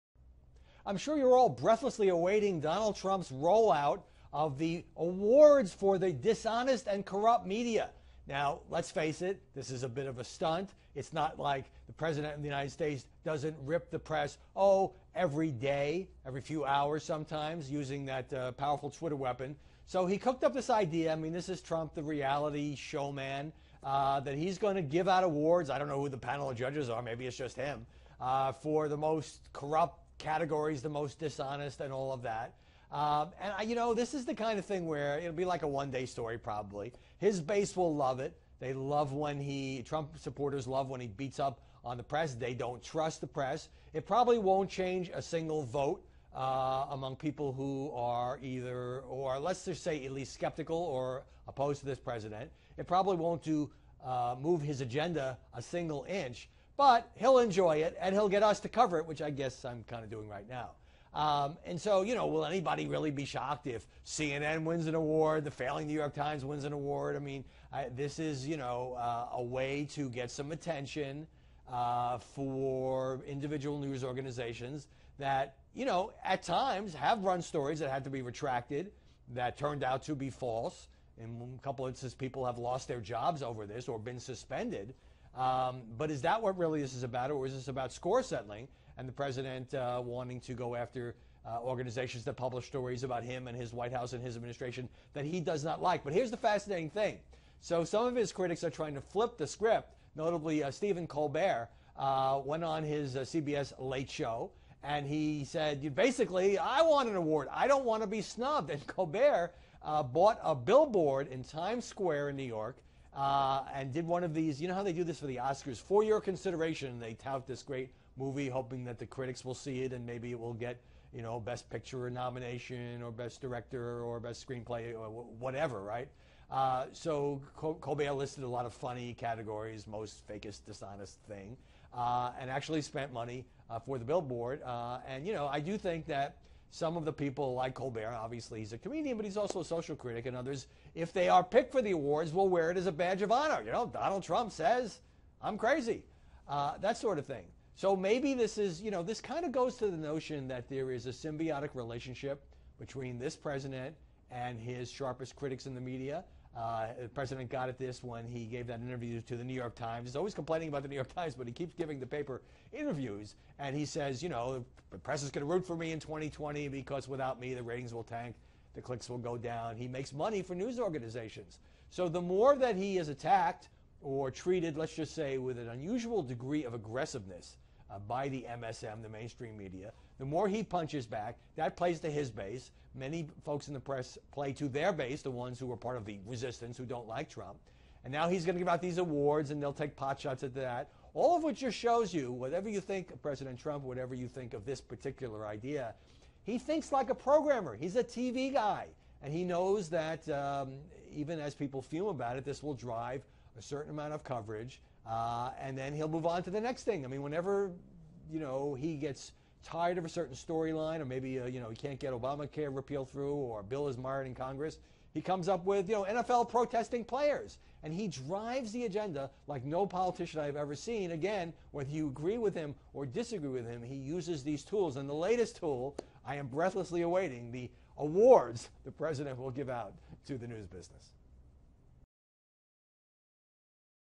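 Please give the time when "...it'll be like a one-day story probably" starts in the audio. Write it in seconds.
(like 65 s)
35 s.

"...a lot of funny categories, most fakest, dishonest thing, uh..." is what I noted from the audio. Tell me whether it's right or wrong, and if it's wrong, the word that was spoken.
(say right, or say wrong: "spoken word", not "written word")
right.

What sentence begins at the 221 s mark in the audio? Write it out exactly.
Again, whether you agree with him or disagree with him, he uses these tools.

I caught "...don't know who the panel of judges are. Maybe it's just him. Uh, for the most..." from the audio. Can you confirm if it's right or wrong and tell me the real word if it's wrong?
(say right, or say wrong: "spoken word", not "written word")
right.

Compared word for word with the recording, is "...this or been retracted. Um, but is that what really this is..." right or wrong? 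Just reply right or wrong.
wrong.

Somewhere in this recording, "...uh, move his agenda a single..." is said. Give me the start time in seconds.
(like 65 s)
54 s.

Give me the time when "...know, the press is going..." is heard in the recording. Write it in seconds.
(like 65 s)
164 s.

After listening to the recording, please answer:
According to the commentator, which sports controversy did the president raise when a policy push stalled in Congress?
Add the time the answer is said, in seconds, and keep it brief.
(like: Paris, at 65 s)
NFL protesting players, at 216 s.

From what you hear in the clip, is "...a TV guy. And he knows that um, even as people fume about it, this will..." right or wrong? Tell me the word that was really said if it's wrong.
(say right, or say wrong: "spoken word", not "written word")
right.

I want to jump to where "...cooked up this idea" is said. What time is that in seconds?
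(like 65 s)
20 s.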